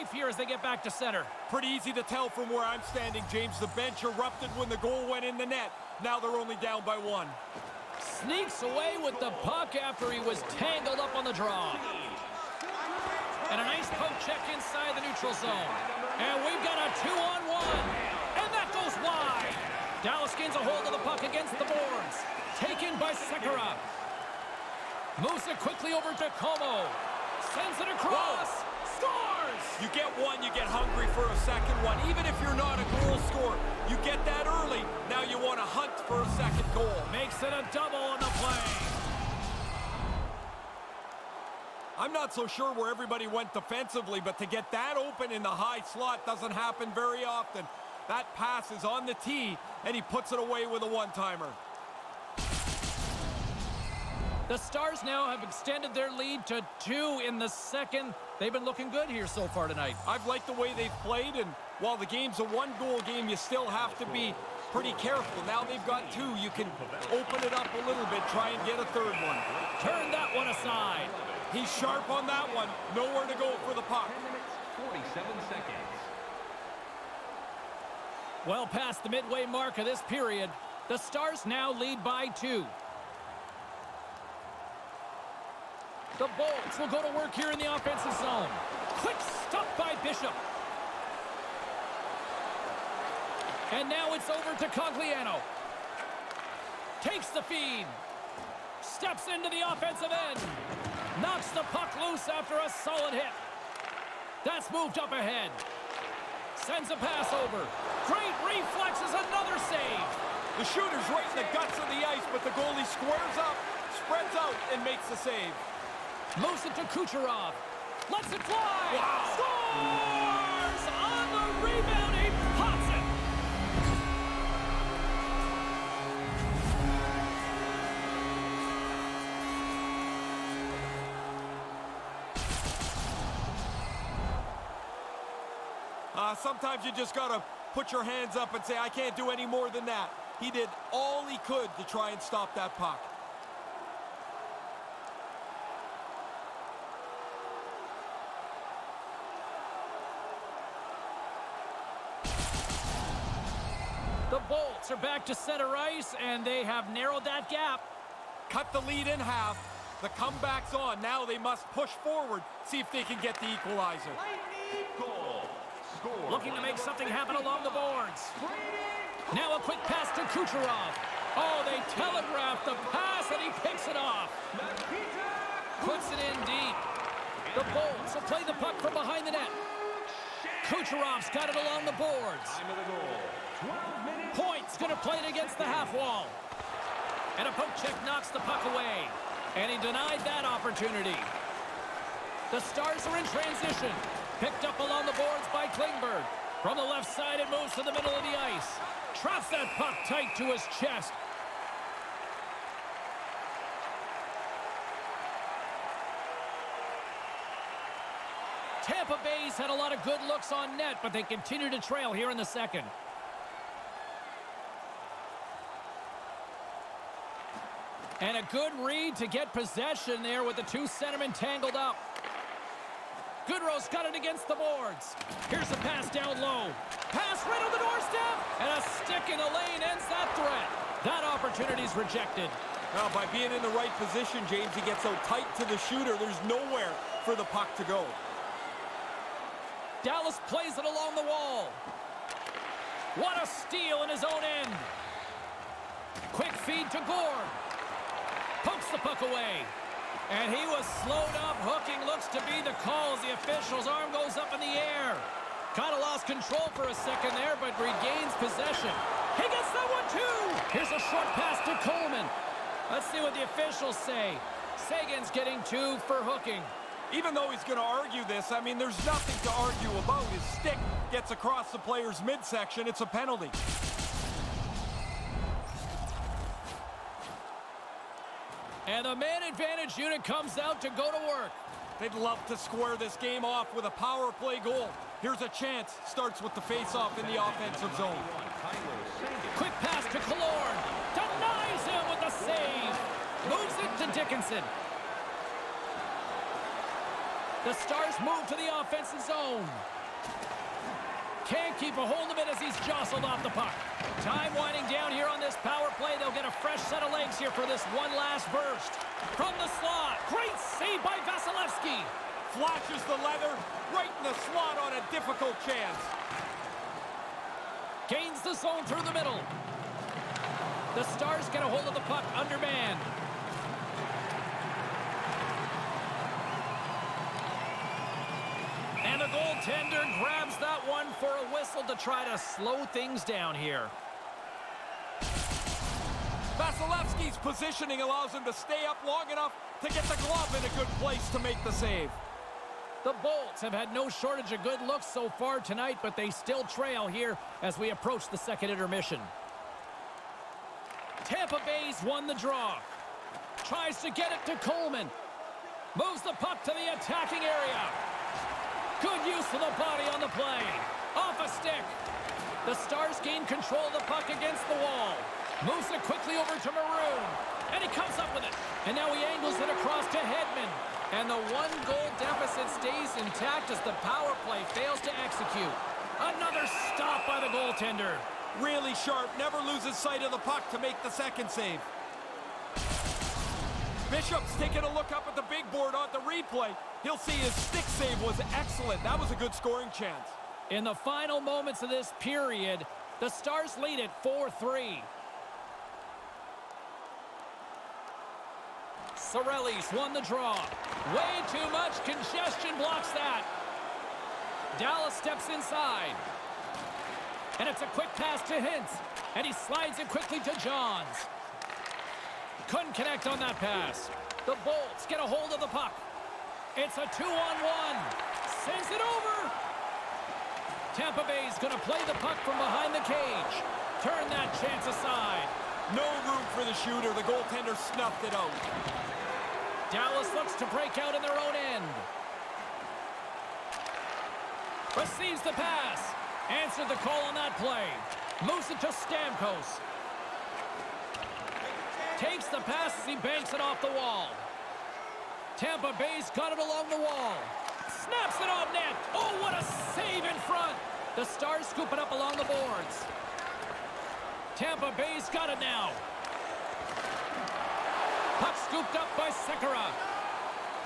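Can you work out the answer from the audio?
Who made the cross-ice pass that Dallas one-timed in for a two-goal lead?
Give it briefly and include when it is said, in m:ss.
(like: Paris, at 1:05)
Comeau, at 0:26.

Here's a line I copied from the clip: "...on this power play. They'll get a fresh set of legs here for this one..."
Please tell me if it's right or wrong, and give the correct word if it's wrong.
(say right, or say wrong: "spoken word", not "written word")
right.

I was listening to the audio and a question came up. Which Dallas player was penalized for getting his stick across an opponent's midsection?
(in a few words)
Seguin.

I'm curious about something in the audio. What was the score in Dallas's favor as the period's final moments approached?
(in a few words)
4-3.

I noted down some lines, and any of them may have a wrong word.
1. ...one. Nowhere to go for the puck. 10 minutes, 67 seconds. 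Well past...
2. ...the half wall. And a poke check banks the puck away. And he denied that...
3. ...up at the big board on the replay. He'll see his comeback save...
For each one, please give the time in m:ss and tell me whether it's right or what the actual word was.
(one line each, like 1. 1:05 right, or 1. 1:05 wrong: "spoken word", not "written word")
1. 1:12 wrong: "47", not "67"
2. 3:05 wrong: "knocks", not "banks"
3. 6:25 wrong: "stick", not "comeback".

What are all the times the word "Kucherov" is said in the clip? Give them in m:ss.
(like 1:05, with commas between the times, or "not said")
1:56, 2:50, 3:00.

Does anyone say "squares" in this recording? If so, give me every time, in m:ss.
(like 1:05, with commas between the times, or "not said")
1:52, 4:42.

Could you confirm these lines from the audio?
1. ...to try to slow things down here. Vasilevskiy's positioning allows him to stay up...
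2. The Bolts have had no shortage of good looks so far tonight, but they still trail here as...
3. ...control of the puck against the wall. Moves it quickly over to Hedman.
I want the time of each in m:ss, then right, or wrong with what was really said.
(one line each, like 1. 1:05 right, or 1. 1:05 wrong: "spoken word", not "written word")
1. 5:31 right
2. 5:43 right
3. 6:03 wrong: "Maroon", not "Hedman".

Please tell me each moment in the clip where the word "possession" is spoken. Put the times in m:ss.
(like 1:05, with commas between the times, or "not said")
3:39, 4:18.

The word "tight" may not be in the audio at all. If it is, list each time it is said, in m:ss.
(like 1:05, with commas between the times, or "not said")
3:20, 3:55.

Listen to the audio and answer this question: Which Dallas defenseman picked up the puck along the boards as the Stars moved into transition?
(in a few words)
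Klingberg.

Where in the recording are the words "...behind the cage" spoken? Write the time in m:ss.
7:02.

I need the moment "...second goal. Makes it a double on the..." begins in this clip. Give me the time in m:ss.
0:36.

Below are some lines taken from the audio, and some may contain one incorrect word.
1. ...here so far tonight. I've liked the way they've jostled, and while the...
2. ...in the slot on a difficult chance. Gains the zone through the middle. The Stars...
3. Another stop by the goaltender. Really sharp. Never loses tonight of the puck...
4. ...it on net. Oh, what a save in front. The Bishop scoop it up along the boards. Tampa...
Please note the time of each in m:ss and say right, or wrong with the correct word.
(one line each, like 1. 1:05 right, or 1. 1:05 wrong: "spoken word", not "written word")
1. 0:59 wrong: "played", not "jostled"
2. 5:14 right
3. 6:16 wrong: "sight", not "tonight"
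4. 7:28 wrong: "Stars", not "Bishop".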